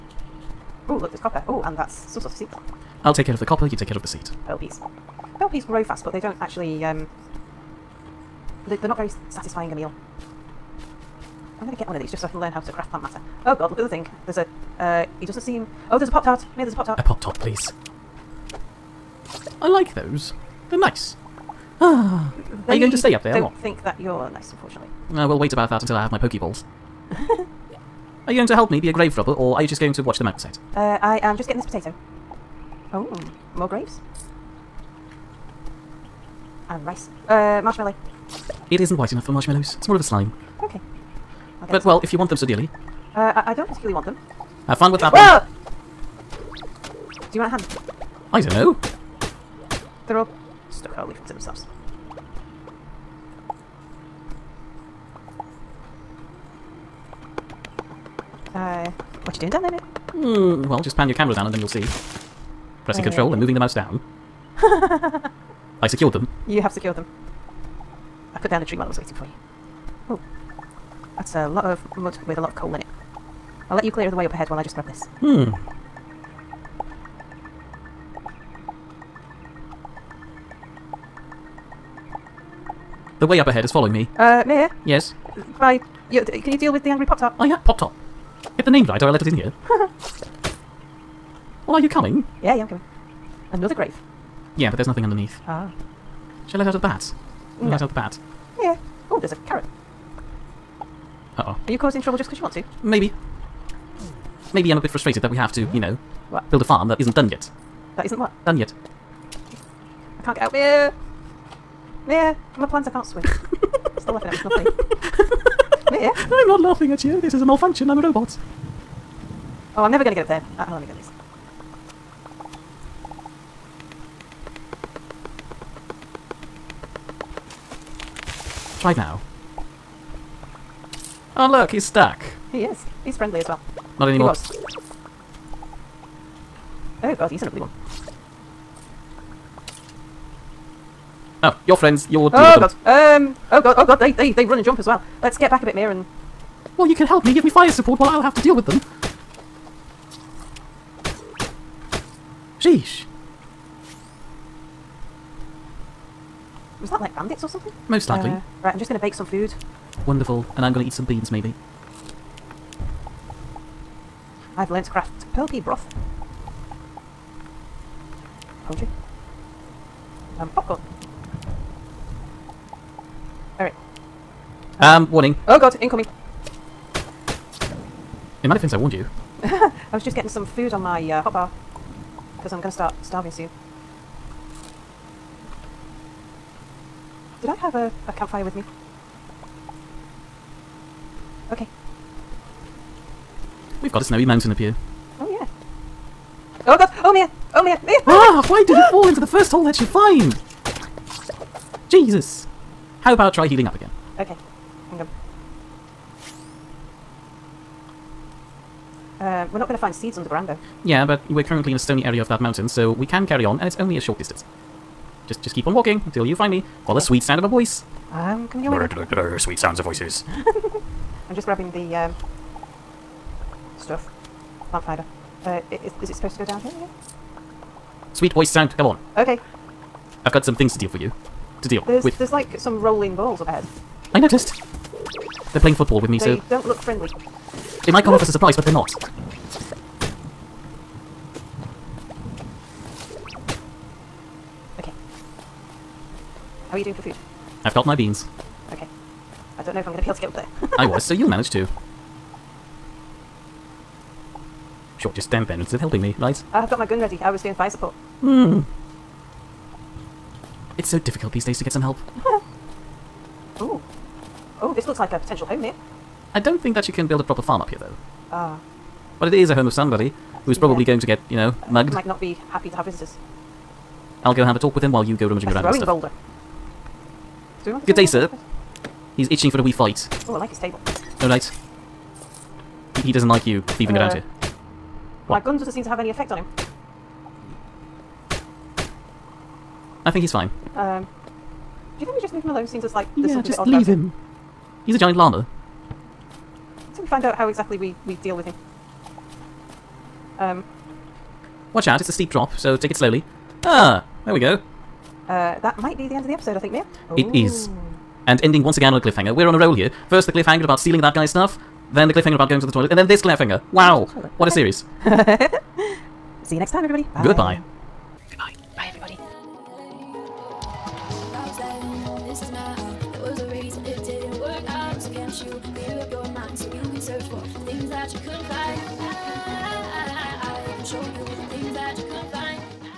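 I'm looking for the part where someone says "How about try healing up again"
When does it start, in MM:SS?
03:23.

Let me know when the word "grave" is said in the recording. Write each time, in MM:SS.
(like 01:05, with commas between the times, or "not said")
00:28, 00:33, 01:33.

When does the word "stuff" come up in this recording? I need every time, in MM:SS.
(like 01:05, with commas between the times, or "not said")
03:43, 04:35, 05:11.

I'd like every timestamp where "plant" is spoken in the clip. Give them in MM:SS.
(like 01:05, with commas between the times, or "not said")
00:12, 01:52, 03:44.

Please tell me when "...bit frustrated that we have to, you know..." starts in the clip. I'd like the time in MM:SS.
01:44.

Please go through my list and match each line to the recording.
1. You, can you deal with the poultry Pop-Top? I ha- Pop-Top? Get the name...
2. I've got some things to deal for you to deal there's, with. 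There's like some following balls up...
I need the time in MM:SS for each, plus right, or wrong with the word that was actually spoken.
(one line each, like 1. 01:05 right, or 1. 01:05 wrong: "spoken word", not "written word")
1. 01:26 wrong: "angry", not "poultry"
2. 03:50 wrong: "rolling", not "following".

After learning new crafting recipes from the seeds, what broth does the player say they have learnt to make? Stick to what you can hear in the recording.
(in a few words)
Pearl pea broth.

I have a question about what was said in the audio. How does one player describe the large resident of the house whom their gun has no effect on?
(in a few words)
A giant llama.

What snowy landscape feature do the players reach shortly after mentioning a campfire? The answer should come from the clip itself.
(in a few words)
Snowy mountain.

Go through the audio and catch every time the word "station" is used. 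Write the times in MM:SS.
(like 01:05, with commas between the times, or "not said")
not said.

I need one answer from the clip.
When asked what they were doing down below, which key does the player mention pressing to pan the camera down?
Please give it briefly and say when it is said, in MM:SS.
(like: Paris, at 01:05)
Control, at 01:03.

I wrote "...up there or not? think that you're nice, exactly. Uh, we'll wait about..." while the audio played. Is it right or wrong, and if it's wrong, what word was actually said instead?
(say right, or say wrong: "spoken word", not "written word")
wrong: "unfortunately", not "exactly".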